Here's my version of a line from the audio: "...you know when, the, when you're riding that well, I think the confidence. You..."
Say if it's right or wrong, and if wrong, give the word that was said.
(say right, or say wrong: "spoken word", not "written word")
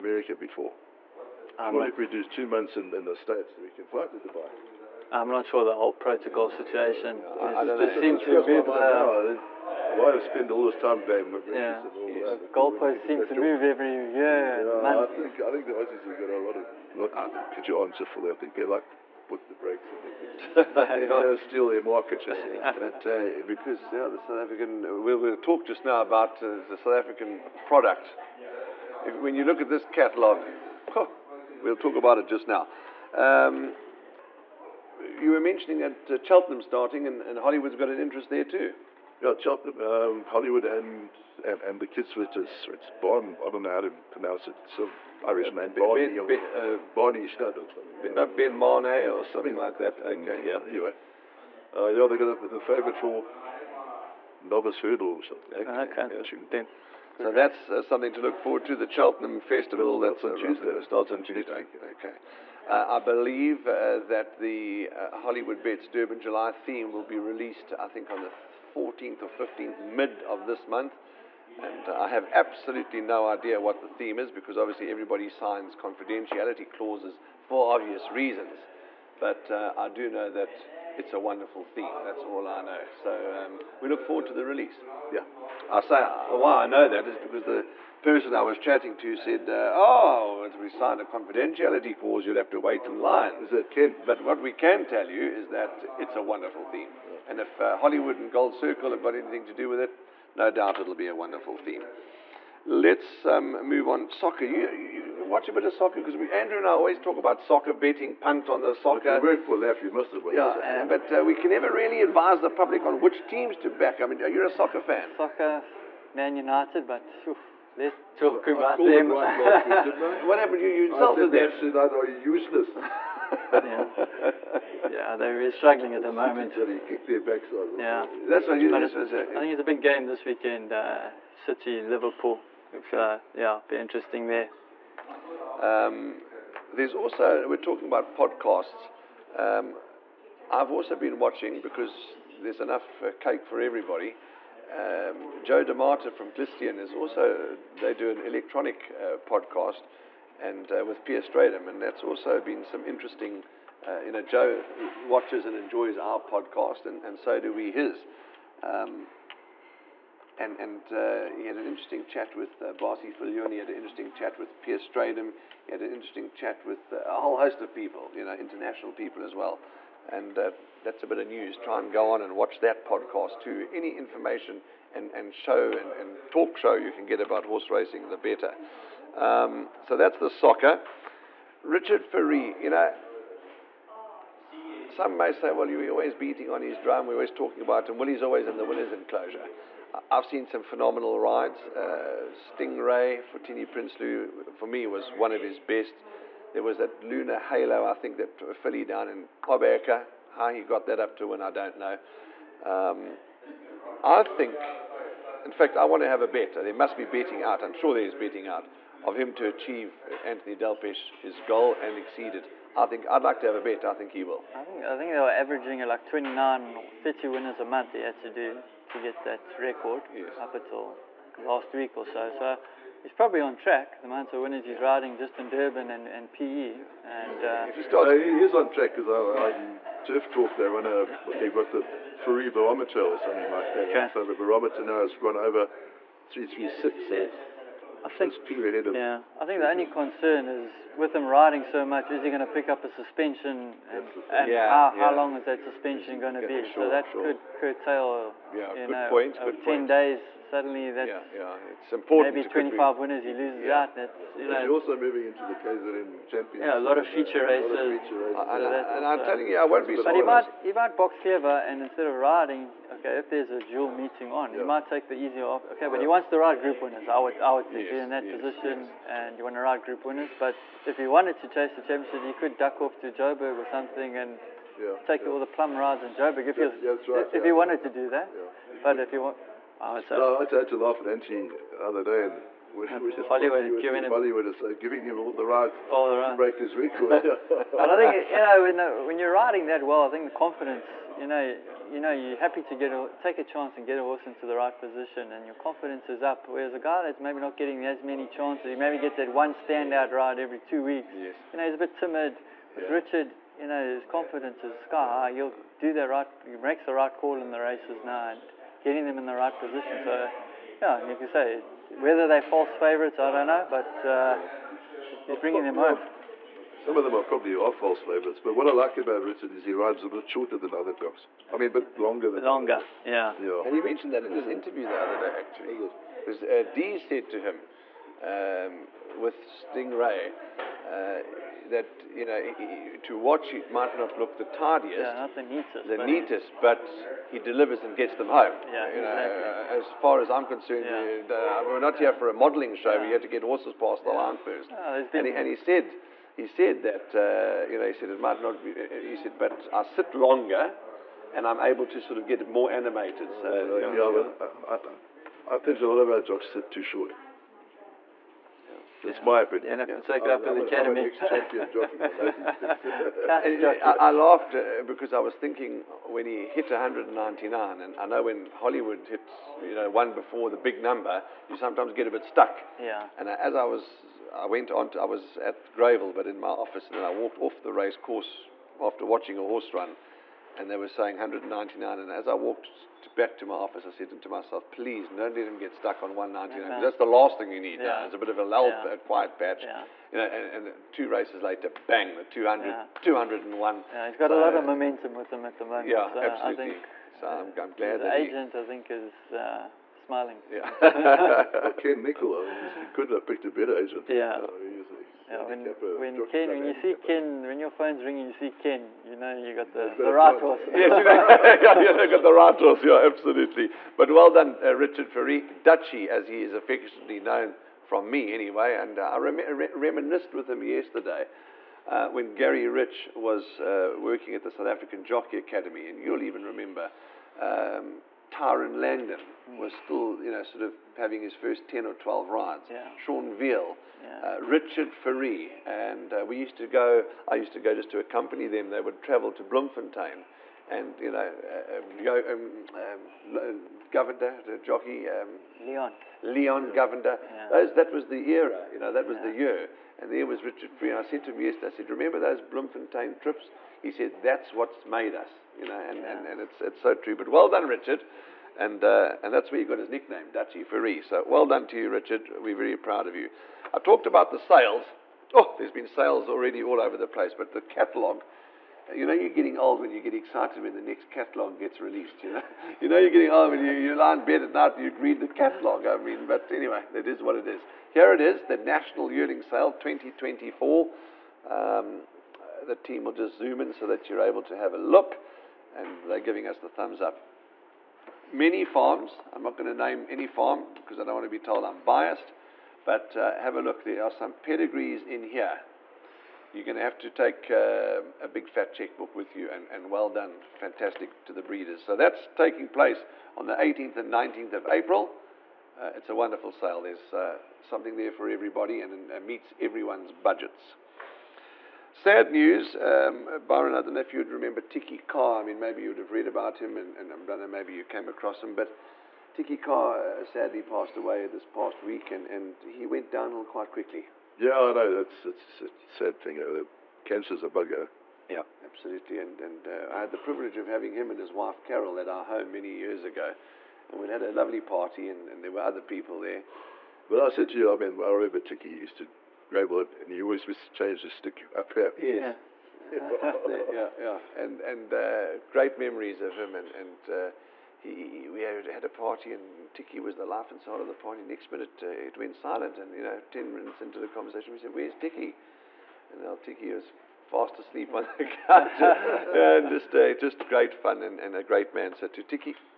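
right.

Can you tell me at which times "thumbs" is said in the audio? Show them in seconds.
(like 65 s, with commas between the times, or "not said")
486 s.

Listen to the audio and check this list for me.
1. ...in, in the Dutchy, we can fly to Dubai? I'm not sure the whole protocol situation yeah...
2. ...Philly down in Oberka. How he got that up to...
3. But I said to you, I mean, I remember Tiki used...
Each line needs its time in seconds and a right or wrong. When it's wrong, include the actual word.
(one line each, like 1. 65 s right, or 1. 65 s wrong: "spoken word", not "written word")
1. 2 s wrong: "States", not "Dutchy"
2. 198 s right
3. 537 s right.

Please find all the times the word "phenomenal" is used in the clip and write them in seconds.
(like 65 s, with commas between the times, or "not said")
190 s.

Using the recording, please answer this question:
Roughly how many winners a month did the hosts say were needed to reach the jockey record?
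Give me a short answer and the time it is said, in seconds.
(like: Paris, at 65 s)
29 or 30, at 216 s.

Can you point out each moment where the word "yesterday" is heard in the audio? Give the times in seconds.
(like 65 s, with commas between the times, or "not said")
420 s, 451 s.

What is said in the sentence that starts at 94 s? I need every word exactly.
But what we can tell you is that it's a wonderful theme, yeah.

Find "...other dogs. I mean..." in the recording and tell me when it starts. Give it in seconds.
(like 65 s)
320 s.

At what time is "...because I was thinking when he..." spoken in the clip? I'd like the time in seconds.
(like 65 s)
364 s.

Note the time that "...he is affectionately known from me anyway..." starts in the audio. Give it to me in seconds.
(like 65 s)
416 s.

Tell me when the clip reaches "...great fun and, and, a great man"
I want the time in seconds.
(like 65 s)
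560 s.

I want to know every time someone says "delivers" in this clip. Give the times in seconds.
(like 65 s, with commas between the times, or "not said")
337 s.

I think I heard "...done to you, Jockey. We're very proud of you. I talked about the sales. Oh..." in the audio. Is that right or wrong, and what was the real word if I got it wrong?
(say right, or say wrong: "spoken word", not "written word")
wrong: "Richard", not "Jockey".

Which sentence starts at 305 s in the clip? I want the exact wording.
He'll do the right, he makes the right call in the races now, and getting them in the right position.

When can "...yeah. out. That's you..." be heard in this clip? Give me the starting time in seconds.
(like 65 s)
253 s.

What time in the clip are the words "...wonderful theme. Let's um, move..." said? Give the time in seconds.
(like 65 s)
101 s.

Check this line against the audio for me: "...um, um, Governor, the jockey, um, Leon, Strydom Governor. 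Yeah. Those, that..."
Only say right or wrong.
wrong.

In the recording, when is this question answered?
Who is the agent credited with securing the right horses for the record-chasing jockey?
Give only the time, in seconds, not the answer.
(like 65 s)
401 s.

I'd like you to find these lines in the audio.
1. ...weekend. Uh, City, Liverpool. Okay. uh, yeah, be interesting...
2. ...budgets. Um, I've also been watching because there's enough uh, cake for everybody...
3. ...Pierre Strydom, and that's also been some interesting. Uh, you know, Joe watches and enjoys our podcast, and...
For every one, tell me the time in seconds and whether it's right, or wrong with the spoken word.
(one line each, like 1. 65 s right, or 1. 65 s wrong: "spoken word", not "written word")
1. 130 s right
2. 138 s wrong: "podcasts", not "budgets"
3. 151 s right.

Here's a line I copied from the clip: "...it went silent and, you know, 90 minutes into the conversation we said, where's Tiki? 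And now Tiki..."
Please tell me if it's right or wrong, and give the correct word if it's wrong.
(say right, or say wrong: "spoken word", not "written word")
wrong: "10", not "90".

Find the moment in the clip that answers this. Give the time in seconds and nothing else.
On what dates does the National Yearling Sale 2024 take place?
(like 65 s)
503 s.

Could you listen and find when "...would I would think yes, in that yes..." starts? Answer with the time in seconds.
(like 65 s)
267 s.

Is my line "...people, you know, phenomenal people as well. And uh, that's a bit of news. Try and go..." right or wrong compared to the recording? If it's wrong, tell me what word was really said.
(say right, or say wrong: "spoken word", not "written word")
wrong: "international", not "phenomenal".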